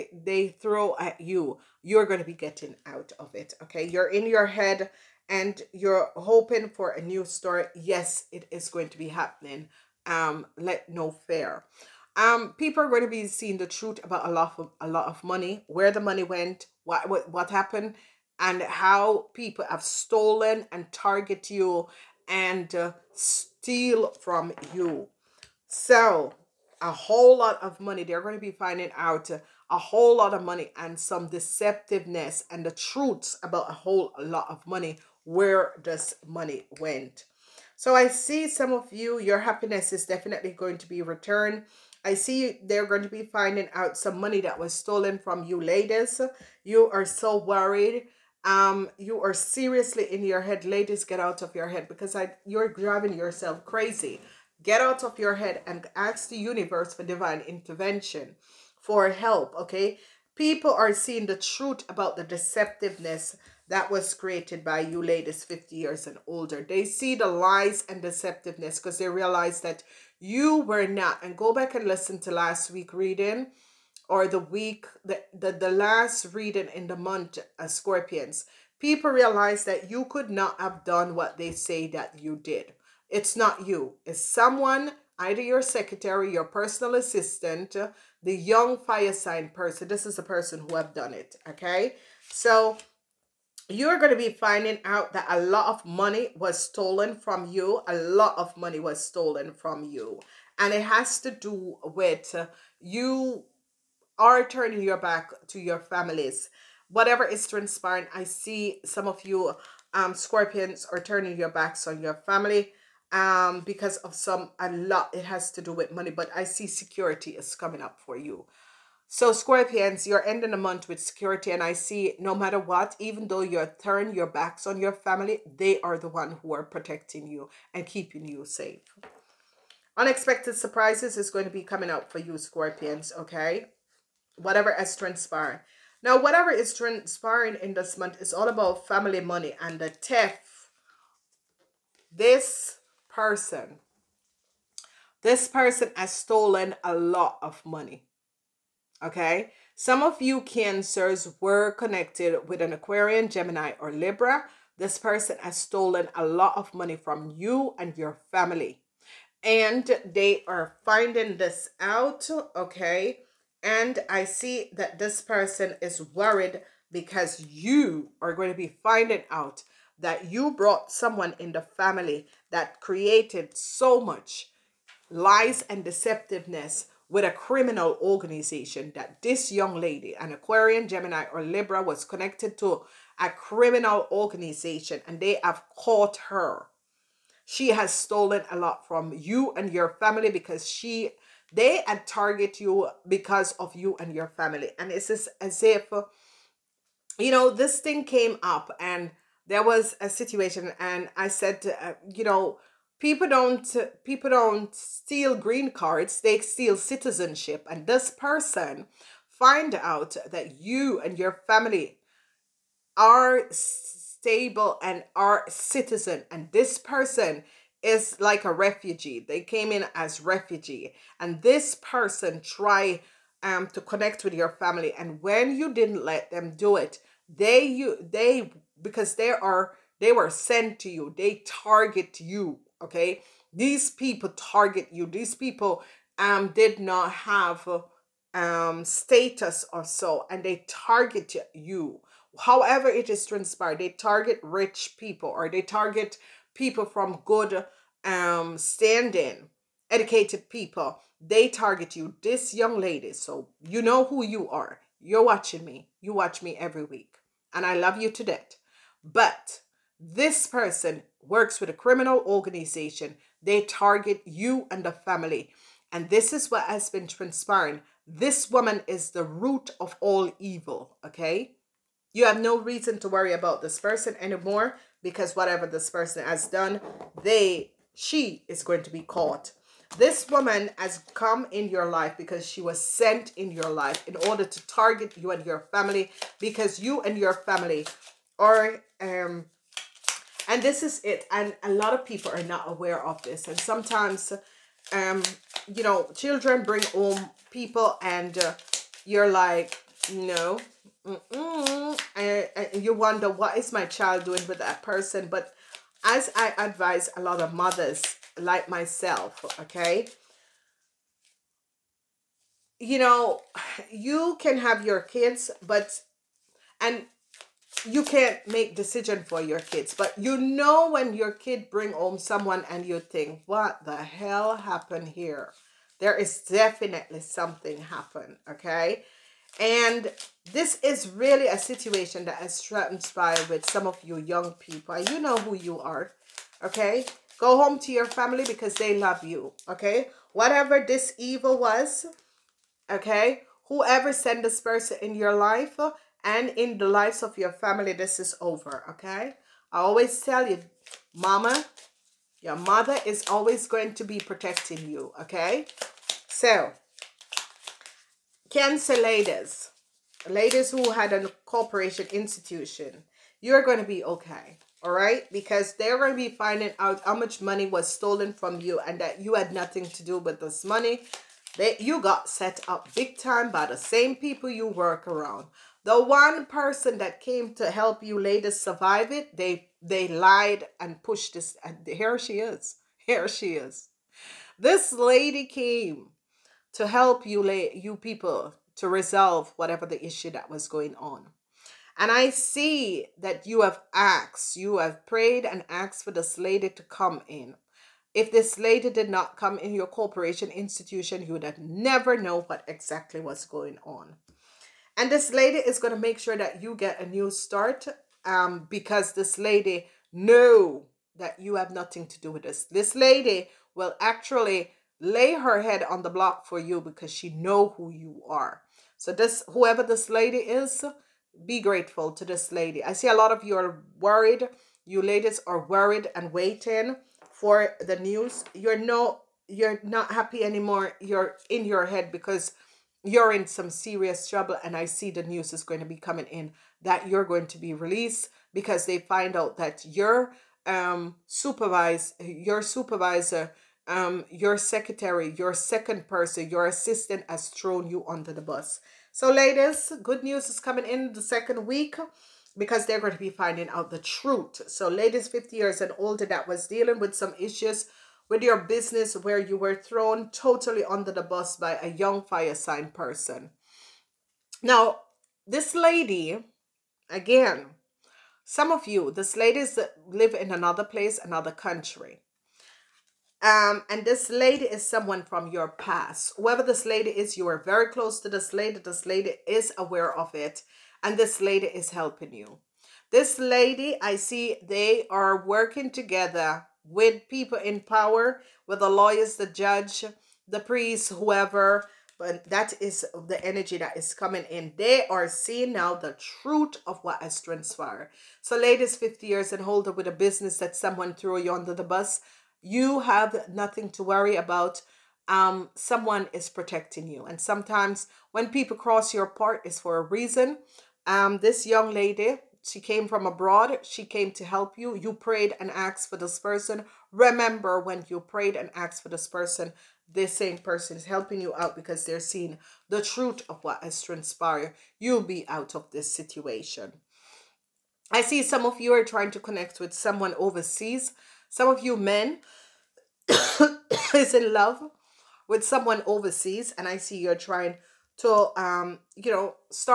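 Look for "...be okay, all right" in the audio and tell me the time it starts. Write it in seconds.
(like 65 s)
363 s.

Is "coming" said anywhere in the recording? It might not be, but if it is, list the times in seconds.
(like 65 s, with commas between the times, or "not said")
117 s, 131 s, 435 s, 450 s, 494 s.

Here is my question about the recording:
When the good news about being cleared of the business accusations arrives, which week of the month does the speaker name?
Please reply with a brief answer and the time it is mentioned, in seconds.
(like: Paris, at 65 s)
Second week, at 451 s.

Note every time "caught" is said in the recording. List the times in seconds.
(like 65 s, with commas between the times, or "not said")
185 s, 279 s.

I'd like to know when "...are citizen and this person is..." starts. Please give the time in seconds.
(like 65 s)
215 s.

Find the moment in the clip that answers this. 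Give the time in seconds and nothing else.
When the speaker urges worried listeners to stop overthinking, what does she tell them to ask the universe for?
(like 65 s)
57 s.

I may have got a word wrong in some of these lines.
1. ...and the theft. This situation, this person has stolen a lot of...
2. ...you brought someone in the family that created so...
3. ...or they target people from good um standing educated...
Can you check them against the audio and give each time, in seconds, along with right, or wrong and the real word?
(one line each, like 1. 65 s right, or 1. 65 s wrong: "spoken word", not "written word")
1. 139 s wrong: "person", not "situation"
2. 170 s right
3. 245 s right.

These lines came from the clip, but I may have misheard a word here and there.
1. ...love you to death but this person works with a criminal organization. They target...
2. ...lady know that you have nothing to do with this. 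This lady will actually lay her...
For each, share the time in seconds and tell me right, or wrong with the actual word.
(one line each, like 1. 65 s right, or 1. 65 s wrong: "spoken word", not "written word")
1. 257 s right
2. 409 s right.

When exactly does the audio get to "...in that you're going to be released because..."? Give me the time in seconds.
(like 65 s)
436 s.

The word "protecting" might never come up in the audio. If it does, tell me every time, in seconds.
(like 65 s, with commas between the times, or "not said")
126 s, 354 s, 506 s.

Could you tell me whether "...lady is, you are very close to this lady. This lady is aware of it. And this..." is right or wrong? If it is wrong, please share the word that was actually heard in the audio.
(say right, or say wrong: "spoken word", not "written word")
right.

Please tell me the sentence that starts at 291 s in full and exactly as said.
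And a lot of people are not aware of this.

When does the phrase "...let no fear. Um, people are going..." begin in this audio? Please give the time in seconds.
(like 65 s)
10 s.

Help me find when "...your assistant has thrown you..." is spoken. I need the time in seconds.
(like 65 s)
446 s.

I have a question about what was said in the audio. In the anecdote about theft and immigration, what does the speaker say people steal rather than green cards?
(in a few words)
Citizenship.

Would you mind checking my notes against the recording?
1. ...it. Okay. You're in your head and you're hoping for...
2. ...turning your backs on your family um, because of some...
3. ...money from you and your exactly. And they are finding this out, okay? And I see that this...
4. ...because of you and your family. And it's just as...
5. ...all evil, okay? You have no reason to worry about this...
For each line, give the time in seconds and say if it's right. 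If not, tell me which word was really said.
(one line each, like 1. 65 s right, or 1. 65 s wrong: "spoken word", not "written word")
1. 3 s right
2. 111 s right
3. 156 s wrong: "family", not "exactly"
4. 193 s right
5. 270 s right.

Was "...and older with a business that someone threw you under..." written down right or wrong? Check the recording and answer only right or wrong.
right.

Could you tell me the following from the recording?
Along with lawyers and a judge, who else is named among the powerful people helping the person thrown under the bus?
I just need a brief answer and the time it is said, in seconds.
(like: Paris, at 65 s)
Priest, at 490 s.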